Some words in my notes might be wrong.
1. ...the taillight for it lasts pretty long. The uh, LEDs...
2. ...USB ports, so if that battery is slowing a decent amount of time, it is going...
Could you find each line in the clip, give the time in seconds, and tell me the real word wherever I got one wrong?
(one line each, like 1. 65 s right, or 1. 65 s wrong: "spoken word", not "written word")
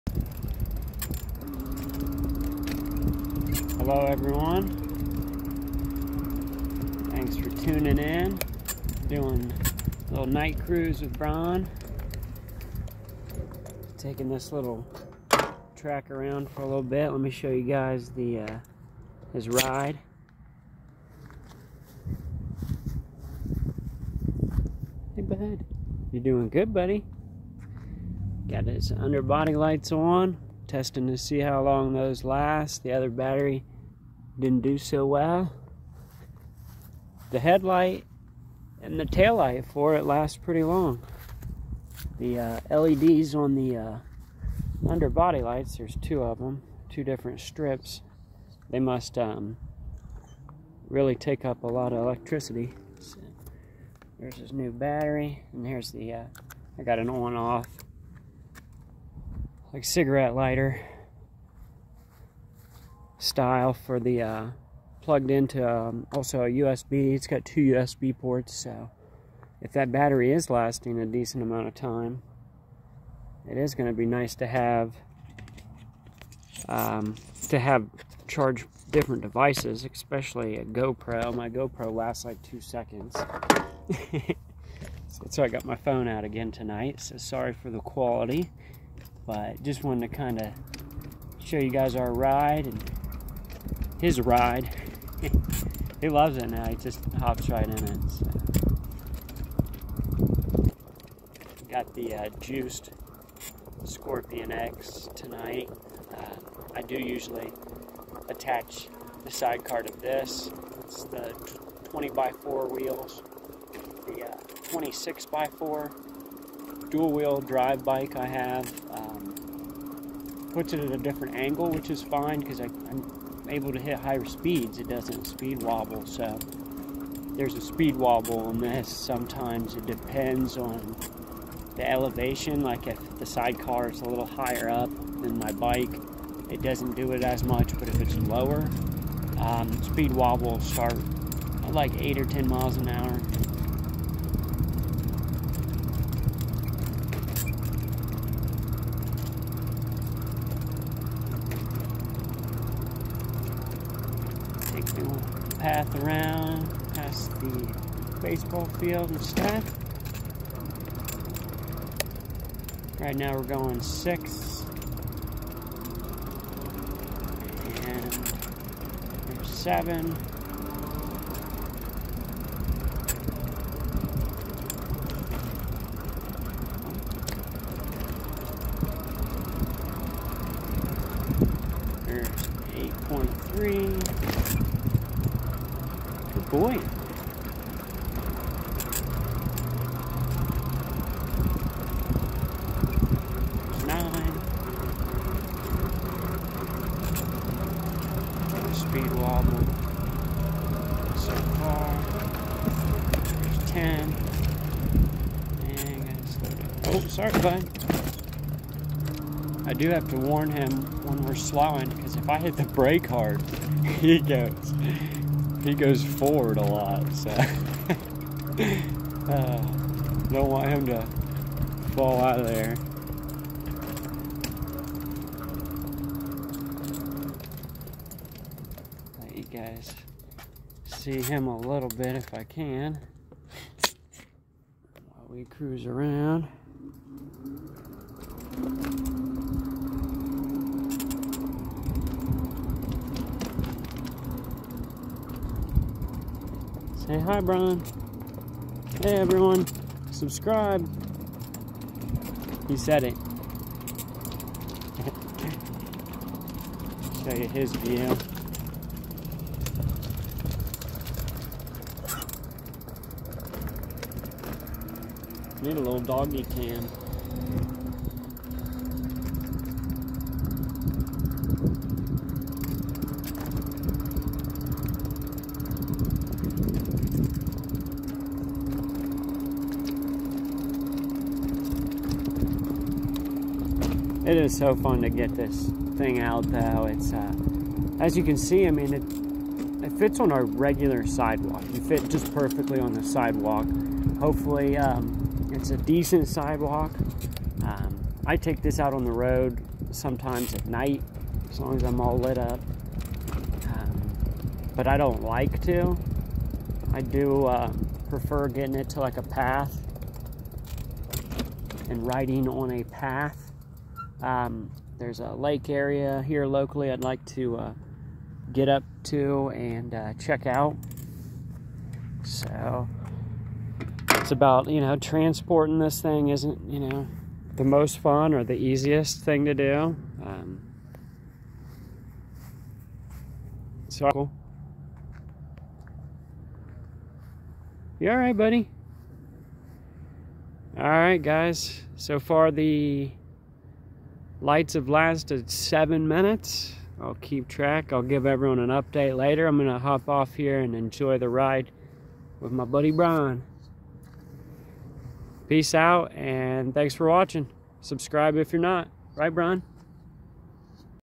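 1. 38 s right
2. 67 s wrong: "lasting", not "slowing".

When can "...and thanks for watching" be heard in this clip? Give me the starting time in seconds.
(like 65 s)
356 s.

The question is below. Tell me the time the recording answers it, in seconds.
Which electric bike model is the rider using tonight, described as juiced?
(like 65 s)
103 s.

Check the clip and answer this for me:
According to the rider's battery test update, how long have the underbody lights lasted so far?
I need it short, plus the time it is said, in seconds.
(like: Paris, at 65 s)
7 minutes, at 345 s.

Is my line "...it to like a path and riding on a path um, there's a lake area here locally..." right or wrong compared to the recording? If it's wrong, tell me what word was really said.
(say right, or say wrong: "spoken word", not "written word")
right.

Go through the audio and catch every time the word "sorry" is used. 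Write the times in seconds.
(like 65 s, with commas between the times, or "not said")
87 s, 207 s.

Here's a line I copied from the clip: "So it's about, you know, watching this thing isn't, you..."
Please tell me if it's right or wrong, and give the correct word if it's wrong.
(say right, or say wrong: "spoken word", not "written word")
wrong: "transporting", not "watching".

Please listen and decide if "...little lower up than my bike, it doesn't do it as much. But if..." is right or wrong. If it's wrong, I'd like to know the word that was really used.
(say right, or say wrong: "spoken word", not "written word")
wrong: "higher", not "lower".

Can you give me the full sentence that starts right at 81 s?
My GoPro lasts like two seconds.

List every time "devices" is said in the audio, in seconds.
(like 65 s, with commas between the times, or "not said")
79 s.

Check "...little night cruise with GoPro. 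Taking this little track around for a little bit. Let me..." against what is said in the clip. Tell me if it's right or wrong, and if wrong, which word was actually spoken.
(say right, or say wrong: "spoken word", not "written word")
wrong: "Bron", not "GoPro".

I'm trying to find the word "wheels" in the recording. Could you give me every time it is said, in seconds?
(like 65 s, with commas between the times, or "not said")
112 s, 117 s.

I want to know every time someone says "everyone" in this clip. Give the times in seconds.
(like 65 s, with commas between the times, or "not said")
4 s, 249 s, 348 s.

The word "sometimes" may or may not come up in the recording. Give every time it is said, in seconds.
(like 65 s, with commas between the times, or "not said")
128 s, 299 s.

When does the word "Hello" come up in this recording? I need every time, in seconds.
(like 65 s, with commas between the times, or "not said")
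3 s.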